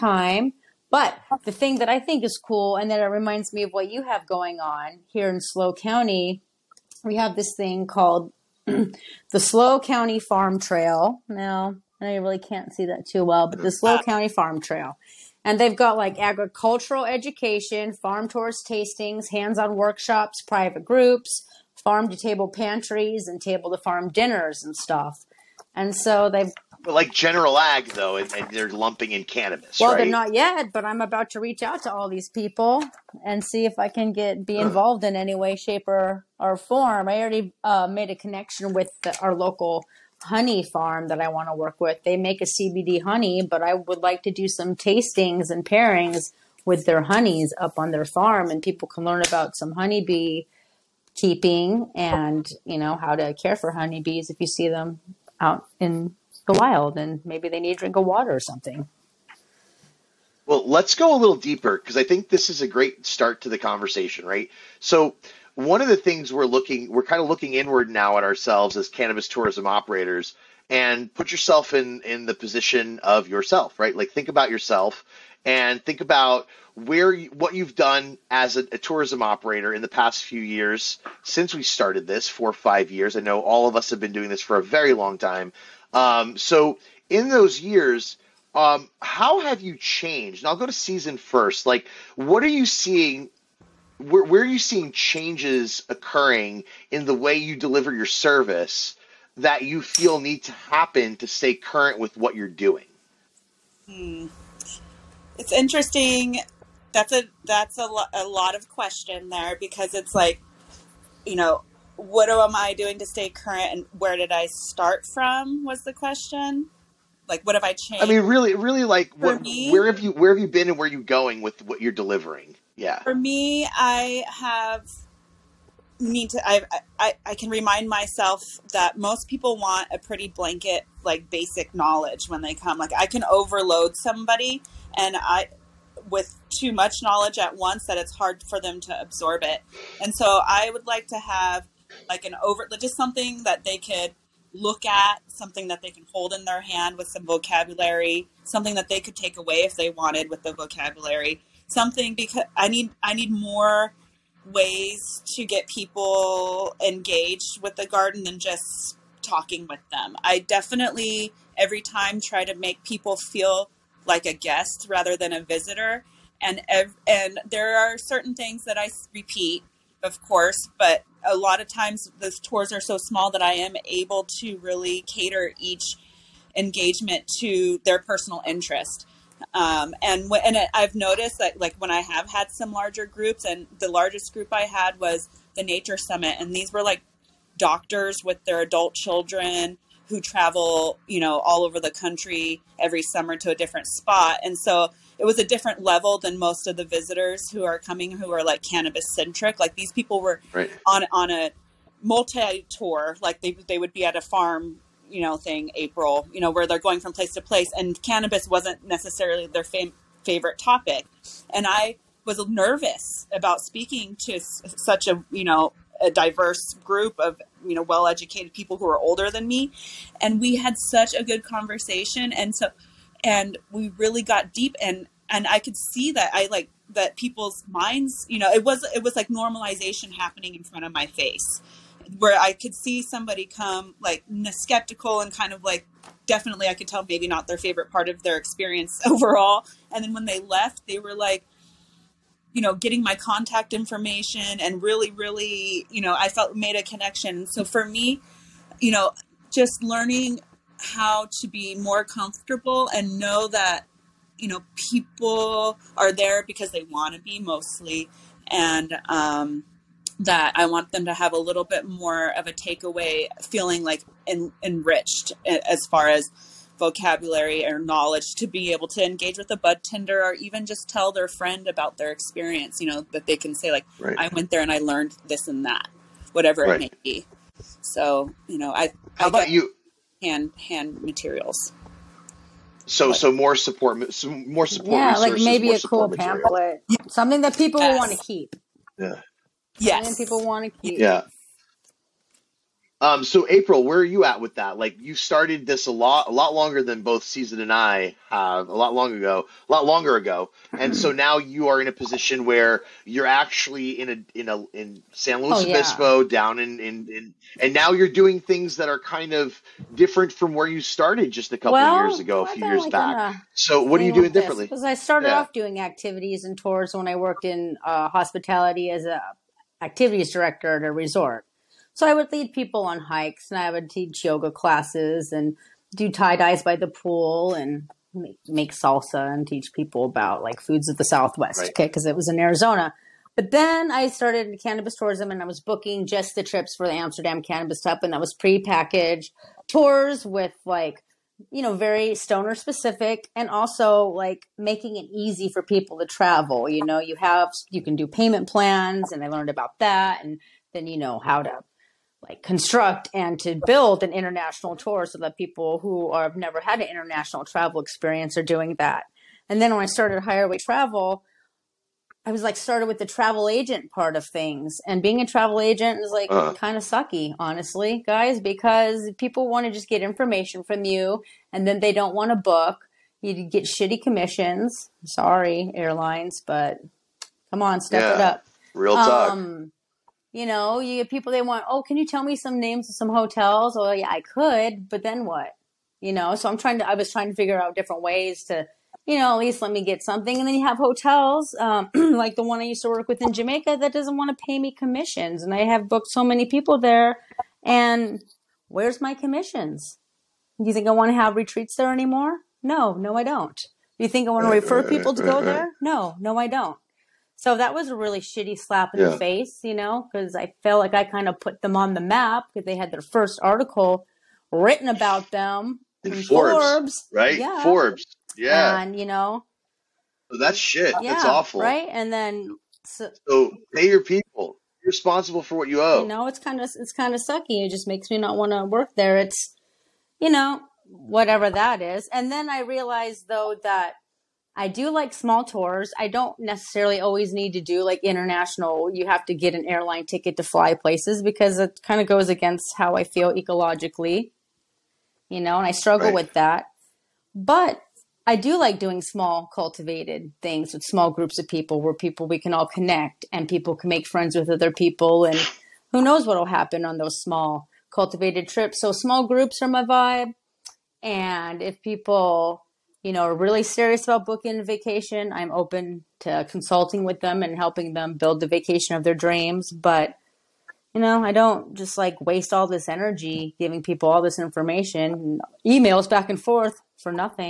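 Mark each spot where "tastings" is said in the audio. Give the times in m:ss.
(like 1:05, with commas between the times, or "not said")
0:18, 0:44.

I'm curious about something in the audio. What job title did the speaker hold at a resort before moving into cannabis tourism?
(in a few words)
activities director.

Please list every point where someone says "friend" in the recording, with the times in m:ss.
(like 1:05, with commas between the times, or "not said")
4:31, 7:34.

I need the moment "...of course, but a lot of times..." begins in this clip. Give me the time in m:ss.
2:50.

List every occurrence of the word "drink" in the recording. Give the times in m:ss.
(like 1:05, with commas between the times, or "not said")
0:57.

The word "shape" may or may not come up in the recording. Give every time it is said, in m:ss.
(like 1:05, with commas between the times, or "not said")
0:35.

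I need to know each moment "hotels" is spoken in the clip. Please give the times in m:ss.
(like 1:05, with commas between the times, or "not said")
6:23, 6:30.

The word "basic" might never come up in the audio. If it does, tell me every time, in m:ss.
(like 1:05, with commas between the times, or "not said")
2:11.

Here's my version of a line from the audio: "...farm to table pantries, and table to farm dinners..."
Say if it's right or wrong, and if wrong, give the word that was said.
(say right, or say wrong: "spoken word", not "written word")
right.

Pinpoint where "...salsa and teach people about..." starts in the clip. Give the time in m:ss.
5:28.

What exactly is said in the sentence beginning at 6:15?
Sorry, airlines, but come on, step yeah, it up.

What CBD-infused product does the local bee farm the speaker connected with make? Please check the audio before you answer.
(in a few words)
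CBD honey.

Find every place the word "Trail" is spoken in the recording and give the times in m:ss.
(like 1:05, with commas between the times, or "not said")
0:10, 0:14.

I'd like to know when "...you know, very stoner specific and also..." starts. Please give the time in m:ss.
5:41.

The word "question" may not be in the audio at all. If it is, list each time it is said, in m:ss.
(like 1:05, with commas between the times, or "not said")
1:48, 1:55.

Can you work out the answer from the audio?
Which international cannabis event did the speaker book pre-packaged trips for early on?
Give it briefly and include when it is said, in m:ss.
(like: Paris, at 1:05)
Amsterdam Cannabis Cup, at 5:36.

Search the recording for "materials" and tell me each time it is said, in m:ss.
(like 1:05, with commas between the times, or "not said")
4:41, 4:46.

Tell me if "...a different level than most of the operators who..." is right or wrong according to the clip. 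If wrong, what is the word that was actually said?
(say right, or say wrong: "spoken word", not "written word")
wrong: "visitors", not "operators".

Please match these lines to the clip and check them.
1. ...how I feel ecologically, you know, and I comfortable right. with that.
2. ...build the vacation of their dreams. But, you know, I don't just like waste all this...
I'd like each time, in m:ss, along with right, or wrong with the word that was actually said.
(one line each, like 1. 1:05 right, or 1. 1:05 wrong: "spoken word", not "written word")
1. 7:22 wrong: "struggle", not "comfortable"
2. 7:48 right.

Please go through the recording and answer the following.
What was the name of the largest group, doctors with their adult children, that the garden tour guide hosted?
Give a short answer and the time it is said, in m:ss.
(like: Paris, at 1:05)
Nature Summit, at 3:05.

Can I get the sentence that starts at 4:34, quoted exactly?
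i went there and i learned this and that whatever right.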